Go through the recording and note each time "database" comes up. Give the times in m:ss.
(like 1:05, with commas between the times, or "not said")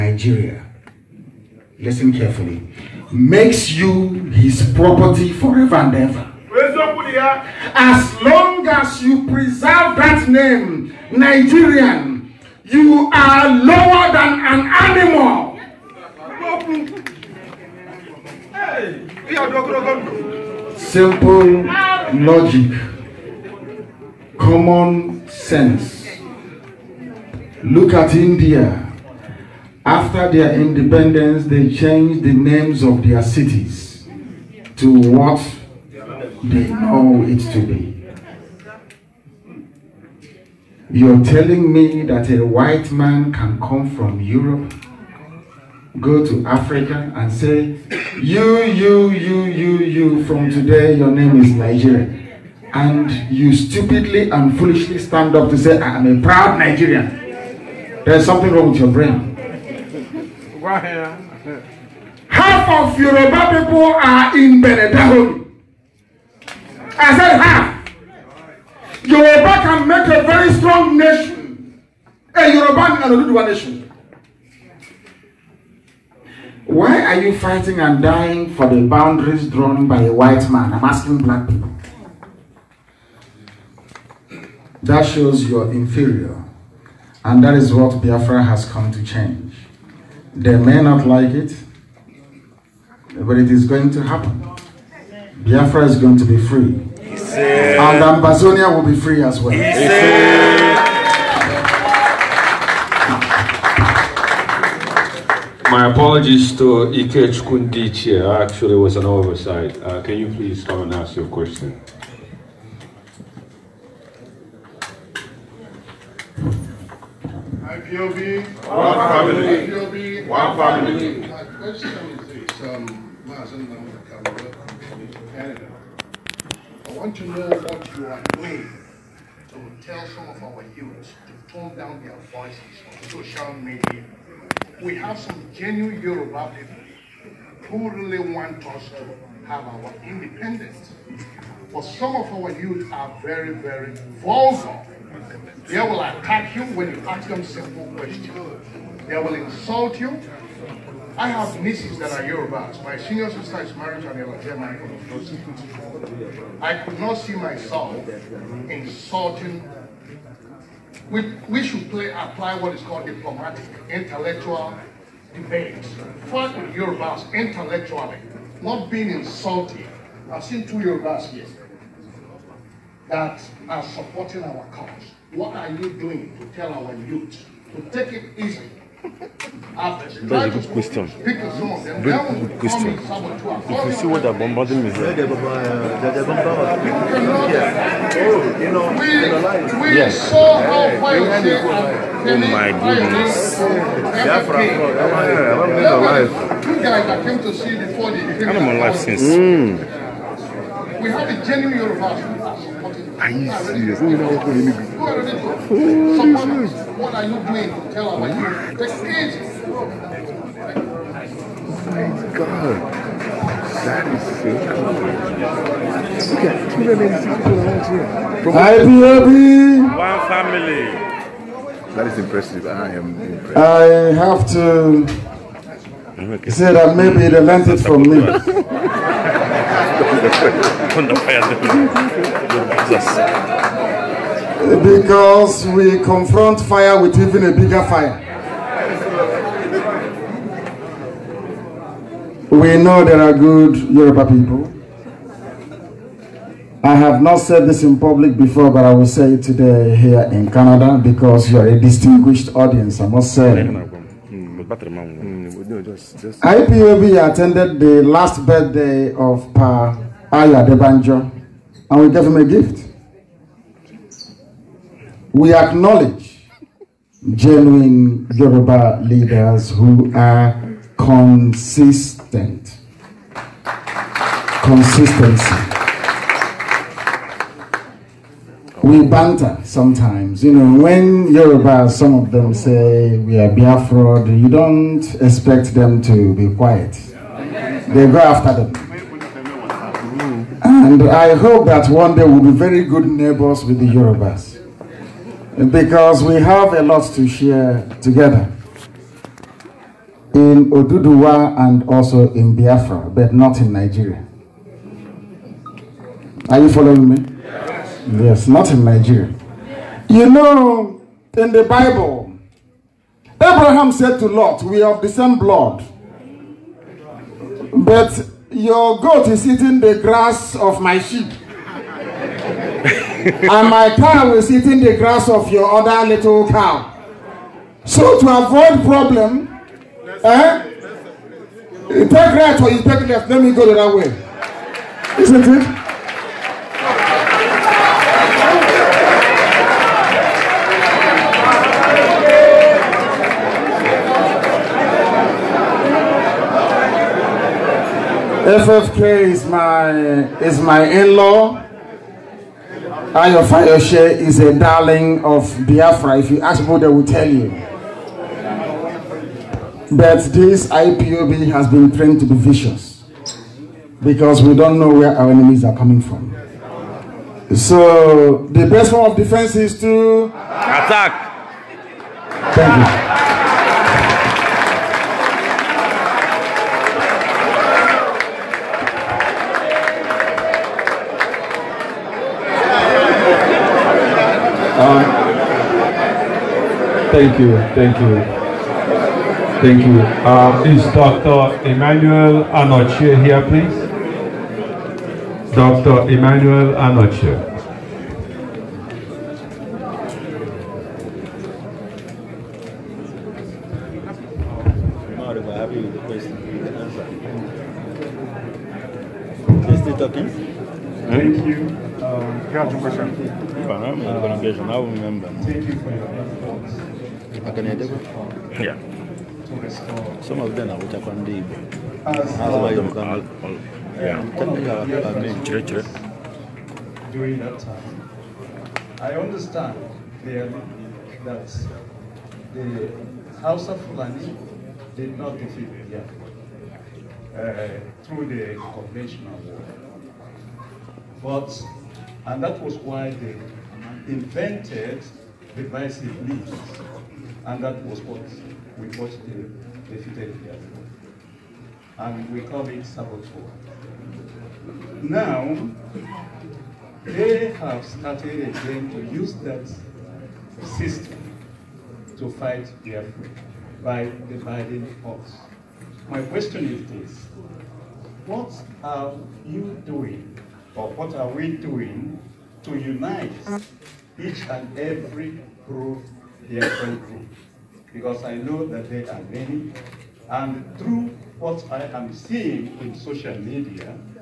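not said.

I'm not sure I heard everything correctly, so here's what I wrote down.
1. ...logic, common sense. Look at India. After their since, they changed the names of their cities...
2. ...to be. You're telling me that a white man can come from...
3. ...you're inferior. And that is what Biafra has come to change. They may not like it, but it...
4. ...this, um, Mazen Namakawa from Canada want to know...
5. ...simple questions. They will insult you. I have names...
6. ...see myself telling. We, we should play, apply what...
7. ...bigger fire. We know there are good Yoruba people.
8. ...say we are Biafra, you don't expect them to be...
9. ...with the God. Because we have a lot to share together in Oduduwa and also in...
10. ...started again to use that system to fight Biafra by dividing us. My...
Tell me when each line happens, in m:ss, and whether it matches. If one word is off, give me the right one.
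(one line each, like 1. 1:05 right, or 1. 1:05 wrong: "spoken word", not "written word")
1. 0:22 wrong: "independence", not "since"
2. 0:37 right
3. 1:25 right
4. 2:02 right
5. 2:27 wrong: "nieces", not "names"
6. 2:37 wrong: "insulting", not "telling"
7. 3:57 right
8. 4:42 right
9. 4:53 wrong: "Yorubas", not "God"
10. 7:37 right.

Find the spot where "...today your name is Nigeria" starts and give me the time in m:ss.
0:50.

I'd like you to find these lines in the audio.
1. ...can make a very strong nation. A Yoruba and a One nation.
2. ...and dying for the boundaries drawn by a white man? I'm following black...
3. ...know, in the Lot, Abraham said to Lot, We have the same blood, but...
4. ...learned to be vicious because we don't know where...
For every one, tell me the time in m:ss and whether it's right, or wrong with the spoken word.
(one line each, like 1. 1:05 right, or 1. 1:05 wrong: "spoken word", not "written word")
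1. 1:09 wrong: "Oduduwa", not "One"
2. 1:17 wrong: "asking", not "following"
3. 5:10 wrong: "Bible", not "Lot"
4. 6:01 wrong: "trained", not "learned".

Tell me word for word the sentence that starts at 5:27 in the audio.
So, to avoid problem, eh, you take right or you take left.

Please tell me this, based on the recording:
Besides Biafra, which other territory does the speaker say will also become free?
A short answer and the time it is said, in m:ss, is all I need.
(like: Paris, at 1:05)
Ambazonia, at 1:38.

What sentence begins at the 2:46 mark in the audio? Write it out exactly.
Fight with Yorubas intellectually, not being insulted.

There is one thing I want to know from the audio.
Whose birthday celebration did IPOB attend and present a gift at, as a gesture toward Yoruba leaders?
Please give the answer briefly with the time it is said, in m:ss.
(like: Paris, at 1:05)
Pa Ayo Adebanjo, at 4:19.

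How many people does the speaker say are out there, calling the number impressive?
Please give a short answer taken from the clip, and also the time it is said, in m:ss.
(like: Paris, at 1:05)
286, at 3:36.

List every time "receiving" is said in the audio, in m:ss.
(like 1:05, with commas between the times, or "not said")
not said.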